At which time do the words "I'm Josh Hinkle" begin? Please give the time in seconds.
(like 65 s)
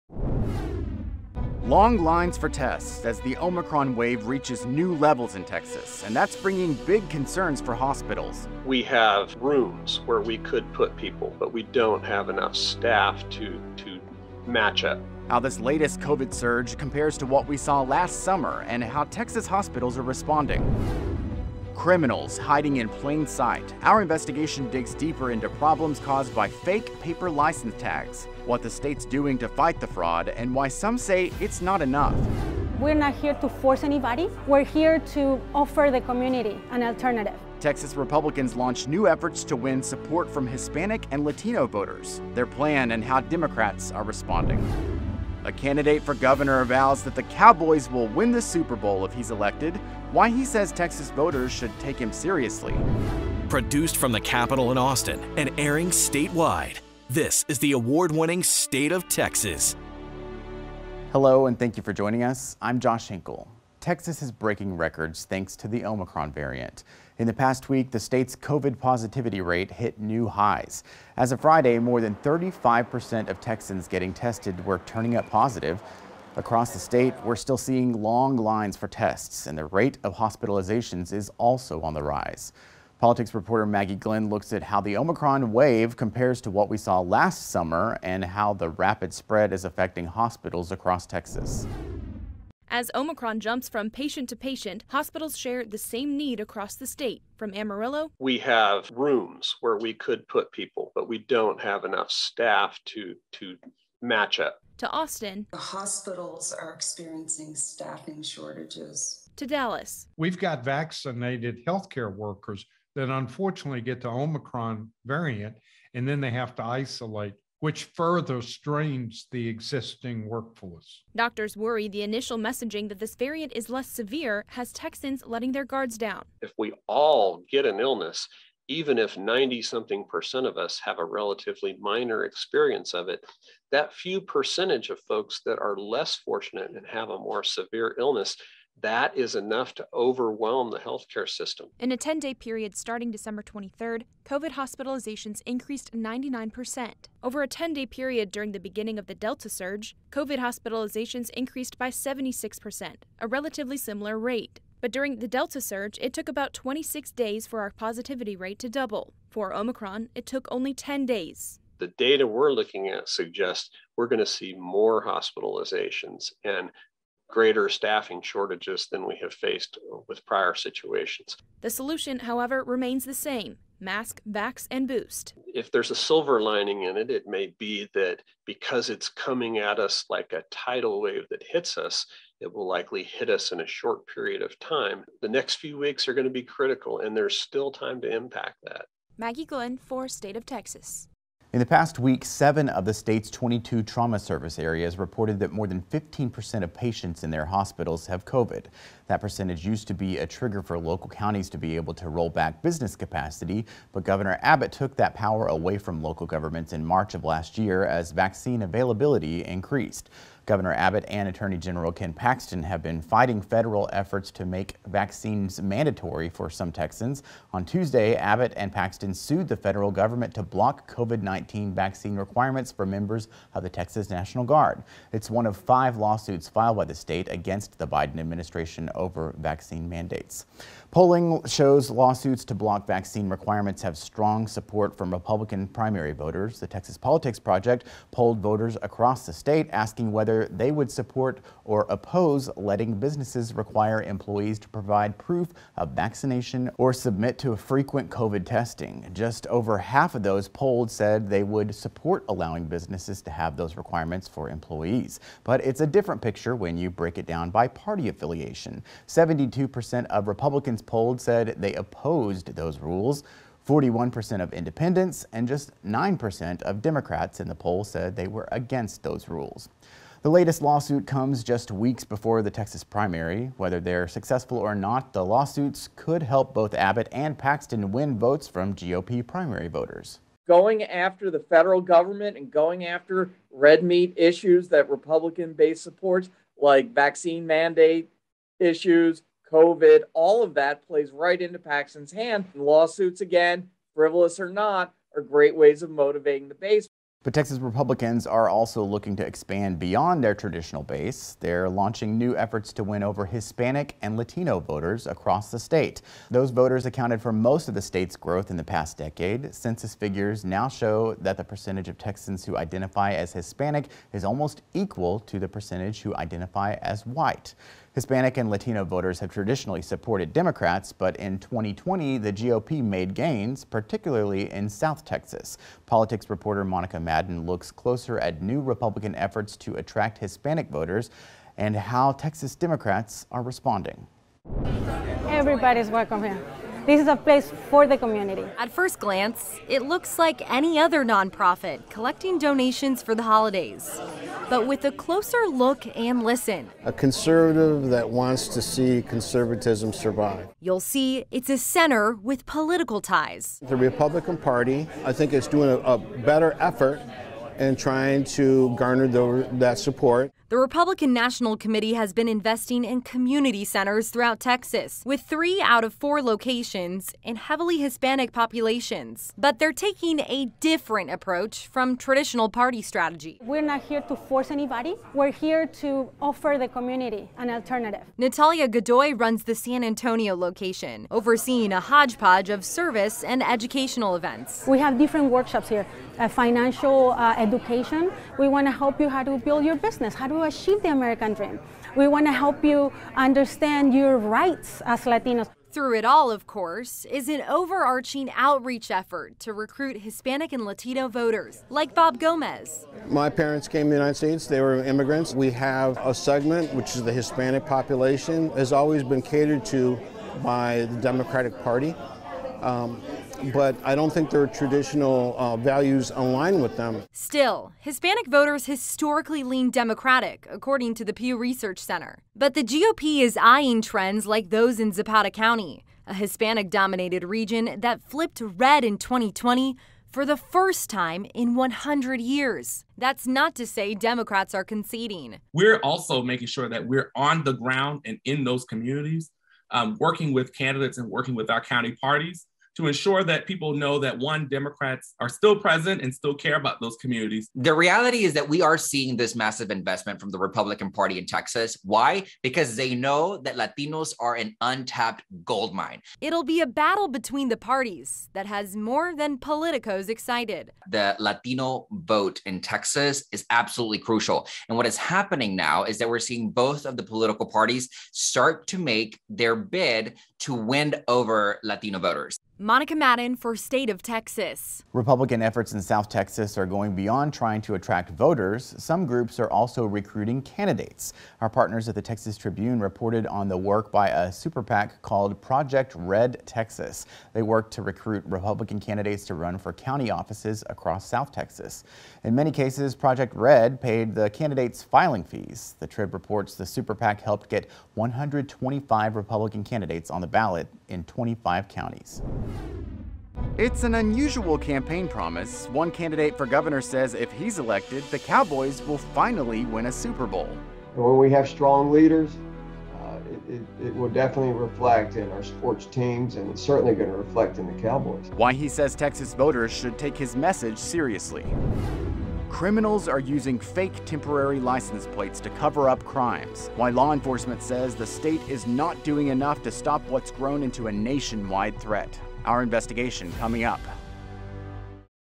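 62 s.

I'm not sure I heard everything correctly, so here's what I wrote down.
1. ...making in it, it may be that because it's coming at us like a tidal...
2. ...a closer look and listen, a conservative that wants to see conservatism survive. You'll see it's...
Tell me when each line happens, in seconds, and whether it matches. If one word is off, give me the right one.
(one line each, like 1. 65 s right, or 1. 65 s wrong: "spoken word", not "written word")
1. 176 s wrong: "lining", not "making"
2. 344 s right.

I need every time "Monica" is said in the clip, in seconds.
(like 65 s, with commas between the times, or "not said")
326 s, 472 s.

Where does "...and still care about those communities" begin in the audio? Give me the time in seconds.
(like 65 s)
446 s.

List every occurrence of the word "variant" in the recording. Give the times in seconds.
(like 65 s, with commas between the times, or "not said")
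66 s, 115 s, 123 s.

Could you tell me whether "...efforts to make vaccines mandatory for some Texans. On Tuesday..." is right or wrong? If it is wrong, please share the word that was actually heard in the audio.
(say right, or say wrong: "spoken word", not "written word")
right.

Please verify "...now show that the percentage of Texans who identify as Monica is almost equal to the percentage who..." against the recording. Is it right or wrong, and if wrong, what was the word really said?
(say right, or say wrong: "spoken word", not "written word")
wrong: "Hispanic", not "Monica".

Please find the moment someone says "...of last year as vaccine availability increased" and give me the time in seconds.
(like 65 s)
207 s.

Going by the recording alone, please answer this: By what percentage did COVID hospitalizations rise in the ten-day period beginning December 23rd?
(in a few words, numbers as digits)
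99%.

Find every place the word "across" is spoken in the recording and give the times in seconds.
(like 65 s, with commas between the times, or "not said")
76 s, 90 s, 96 s, 238 s, 305 s, 490 s.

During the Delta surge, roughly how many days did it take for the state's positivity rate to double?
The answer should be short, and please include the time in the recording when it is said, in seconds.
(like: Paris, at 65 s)
26 days, at 156 s.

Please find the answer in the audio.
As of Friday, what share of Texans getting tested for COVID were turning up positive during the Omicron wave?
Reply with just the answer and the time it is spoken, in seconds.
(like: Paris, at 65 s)
more than 35%, at 71 s.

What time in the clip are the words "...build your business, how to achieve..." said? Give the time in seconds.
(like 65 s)
389 s.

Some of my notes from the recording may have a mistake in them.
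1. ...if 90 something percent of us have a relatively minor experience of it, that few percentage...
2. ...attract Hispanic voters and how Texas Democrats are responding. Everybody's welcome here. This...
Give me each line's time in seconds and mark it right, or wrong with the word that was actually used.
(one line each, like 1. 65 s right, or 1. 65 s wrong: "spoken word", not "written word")
1. 128 s right
2. 329 s right.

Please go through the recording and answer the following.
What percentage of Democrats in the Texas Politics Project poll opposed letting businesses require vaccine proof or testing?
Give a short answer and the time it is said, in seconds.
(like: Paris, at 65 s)
9%, at 265 s.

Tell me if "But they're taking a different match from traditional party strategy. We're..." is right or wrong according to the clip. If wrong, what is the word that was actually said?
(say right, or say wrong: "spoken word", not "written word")
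wrong: "approach", not "match".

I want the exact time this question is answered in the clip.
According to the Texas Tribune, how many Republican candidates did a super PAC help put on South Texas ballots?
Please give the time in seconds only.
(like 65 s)
497 s.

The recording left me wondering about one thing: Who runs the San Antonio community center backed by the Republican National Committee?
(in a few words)
Natalia Godoy.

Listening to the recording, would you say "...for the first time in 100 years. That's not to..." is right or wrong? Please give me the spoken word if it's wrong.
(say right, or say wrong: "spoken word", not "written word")
right.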